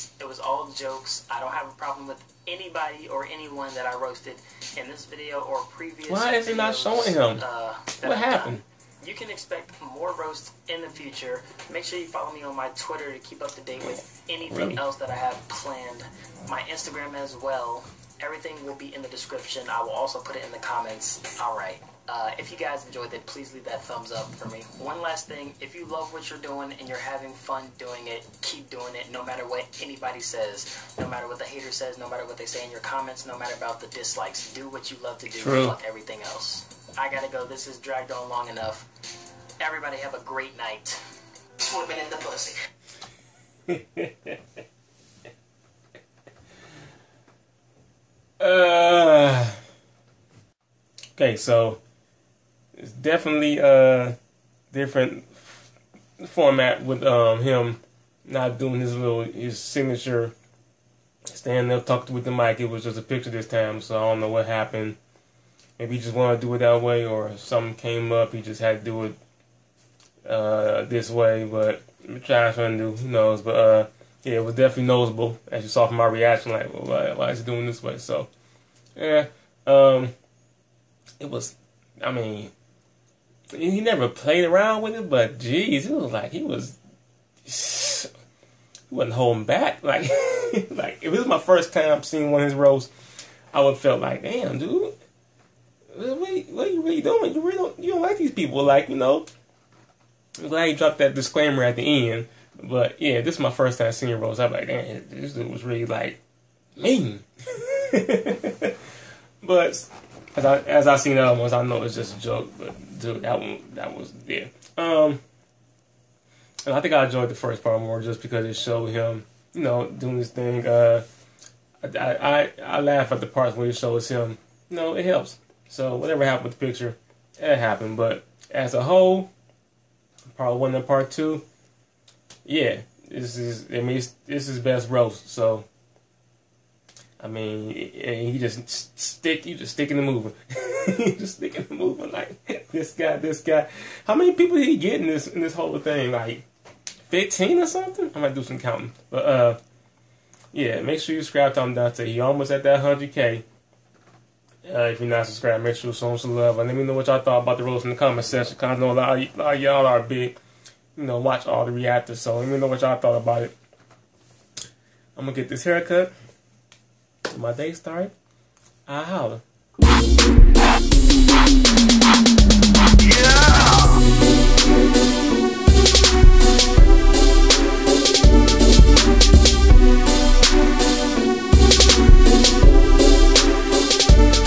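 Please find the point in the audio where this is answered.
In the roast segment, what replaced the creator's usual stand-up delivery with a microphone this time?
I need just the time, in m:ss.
1:02.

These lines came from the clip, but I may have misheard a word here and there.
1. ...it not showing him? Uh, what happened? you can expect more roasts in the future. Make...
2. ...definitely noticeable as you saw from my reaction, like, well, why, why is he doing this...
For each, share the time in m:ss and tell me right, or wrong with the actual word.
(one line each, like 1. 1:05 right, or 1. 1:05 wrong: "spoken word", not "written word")
1. 0:06 right
2. 1:14 right.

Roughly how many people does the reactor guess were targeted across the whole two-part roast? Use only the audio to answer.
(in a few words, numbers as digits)
15.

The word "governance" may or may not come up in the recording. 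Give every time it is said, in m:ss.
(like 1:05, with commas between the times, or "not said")
not said.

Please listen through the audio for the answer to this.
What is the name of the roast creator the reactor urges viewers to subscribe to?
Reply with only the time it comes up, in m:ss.
2:31.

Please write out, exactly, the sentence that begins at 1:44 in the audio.
I'm like, man, this dude was really like mean.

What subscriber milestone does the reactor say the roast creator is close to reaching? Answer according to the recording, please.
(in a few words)
100k.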